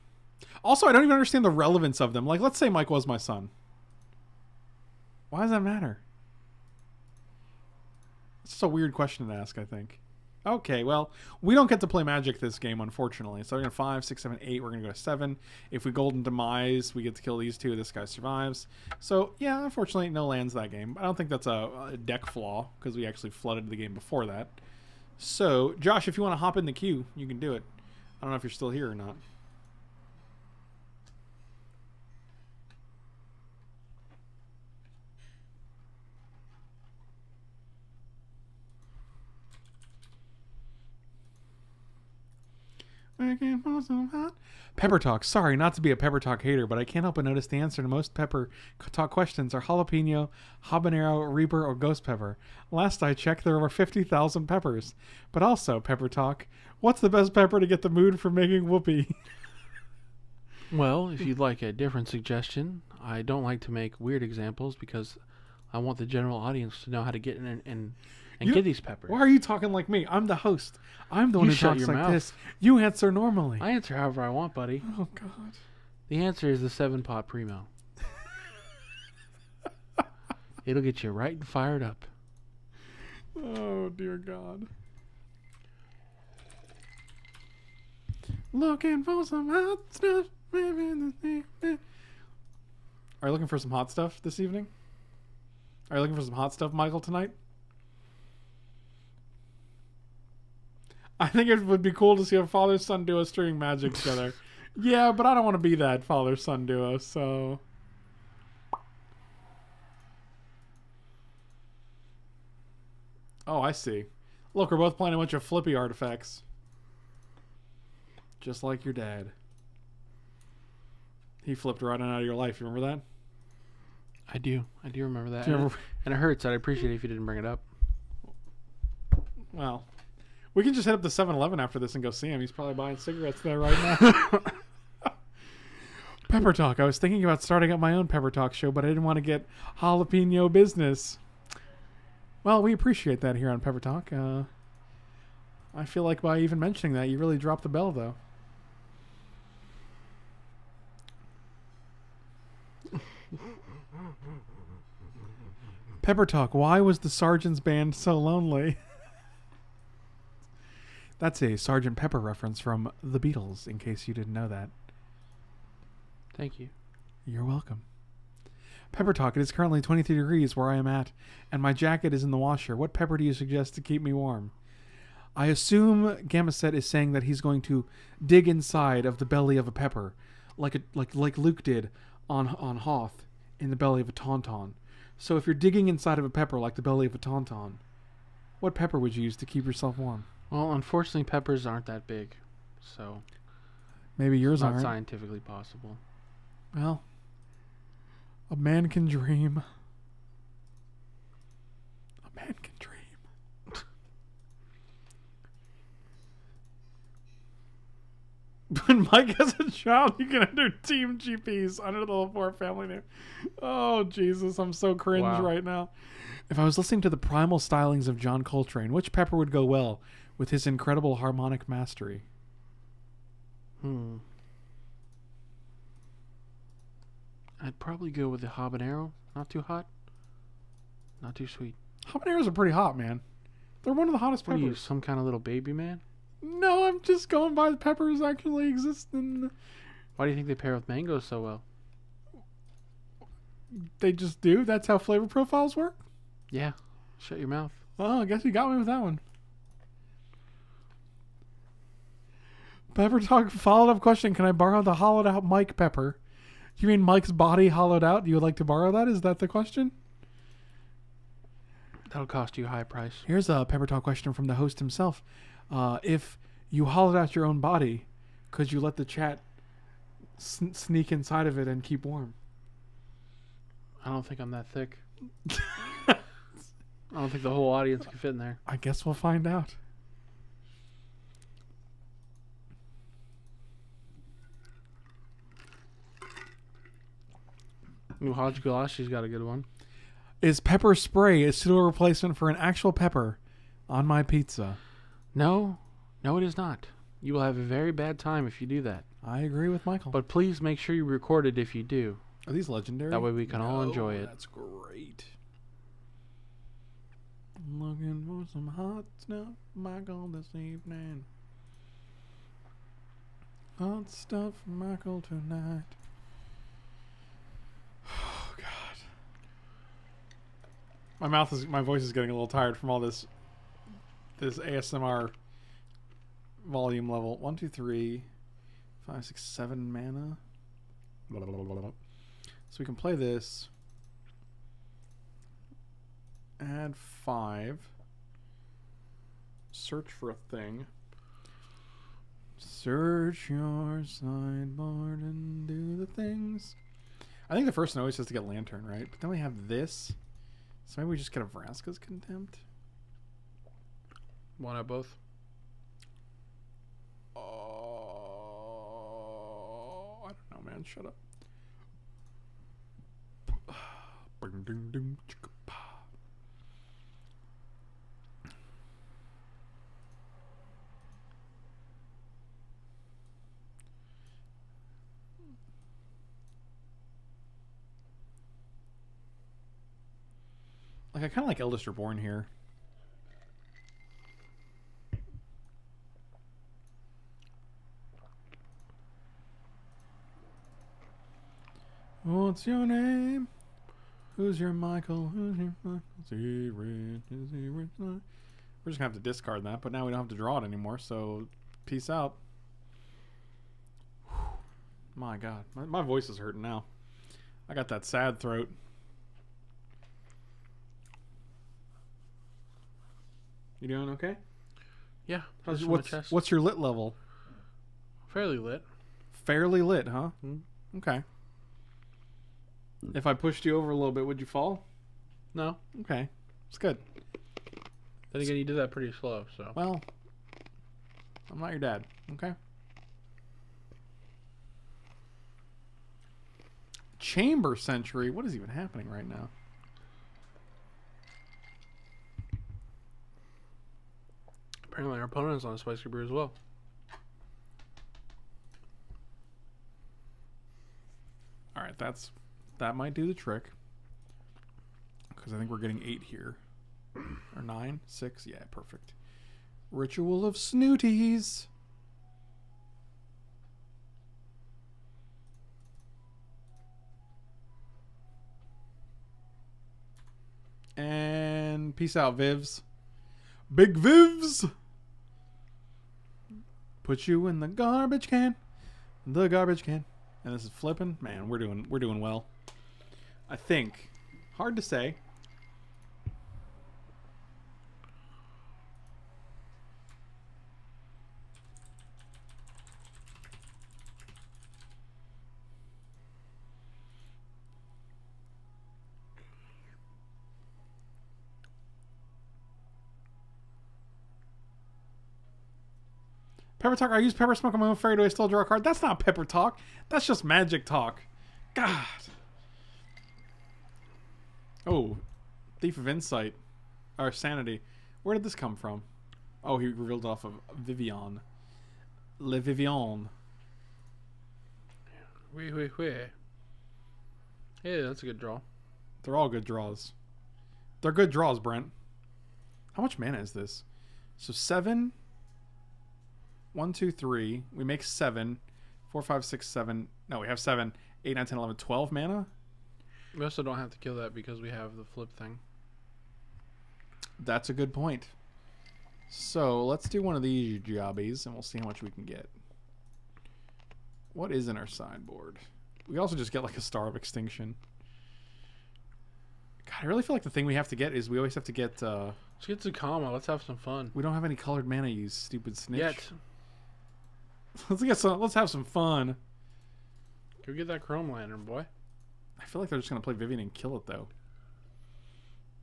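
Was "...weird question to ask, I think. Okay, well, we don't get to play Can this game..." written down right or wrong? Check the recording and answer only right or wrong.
wrong.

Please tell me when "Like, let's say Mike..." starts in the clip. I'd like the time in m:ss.
0:02.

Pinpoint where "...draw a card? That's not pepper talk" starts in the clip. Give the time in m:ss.
8:28.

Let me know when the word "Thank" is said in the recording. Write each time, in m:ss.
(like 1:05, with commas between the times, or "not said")
2:46.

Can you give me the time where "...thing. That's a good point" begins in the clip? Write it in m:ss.
9:05.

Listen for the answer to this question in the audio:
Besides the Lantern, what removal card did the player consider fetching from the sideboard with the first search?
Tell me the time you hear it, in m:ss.
5:51.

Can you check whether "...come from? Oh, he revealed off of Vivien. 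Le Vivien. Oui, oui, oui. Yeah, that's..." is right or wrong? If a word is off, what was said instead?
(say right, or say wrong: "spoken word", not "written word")
right.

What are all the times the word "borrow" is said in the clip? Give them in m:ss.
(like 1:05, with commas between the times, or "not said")
4:14, 4:18.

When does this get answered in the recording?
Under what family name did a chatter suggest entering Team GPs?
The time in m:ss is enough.
3:32.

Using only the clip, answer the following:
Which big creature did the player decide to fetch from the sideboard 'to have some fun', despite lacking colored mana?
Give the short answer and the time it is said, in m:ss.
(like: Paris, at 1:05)
Zacama, at 9:22.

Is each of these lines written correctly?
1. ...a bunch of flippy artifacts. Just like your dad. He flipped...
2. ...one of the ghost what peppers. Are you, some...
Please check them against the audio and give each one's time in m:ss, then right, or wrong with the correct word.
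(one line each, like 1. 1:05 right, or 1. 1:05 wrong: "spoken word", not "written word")
1. 1:55 right
2. 3:53 wrong: "hottest", not "ghost".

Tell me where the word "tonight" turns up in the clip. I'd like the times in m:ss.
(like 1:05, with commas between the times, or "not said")
1:37, 5:15.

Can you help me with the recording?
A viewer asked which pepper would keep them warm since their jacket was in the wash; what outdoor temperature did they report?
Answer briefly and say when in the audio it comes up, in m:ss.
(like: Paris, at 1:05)
23 degrees, at 2:49.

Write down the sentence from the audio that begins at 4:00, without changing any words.
Why do you think they pair with mangoes so well?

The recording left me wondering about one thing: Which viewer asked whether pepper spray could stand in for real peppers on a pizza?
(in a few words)
New Hodge.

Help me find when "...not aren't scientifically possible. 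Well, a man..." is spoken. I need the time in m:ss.
3:14.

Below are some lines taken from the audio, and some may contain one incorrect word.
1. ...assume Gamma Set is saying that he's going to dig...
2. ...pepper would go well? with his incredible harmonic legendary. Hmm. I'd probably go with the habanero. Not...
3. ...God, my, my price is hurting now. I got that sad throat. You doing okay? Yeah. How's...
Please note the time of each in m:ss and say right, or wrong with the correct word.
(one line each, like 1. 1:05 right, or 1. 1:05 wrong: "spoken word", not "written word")
1. 2:55 right
2. 3:39 wrong: "mastery", not "legendary"
3. 6:45 wrong: "voice", not "price".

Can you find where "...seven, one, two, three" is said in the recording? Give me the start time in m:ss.
8:54.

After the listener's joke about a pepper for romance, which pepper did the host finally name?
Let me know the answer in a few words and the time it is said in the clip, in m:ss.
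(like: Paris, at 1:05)
Seven pot primo, at 1:16.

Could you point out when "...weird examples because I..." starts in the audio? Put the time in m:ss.
1:04.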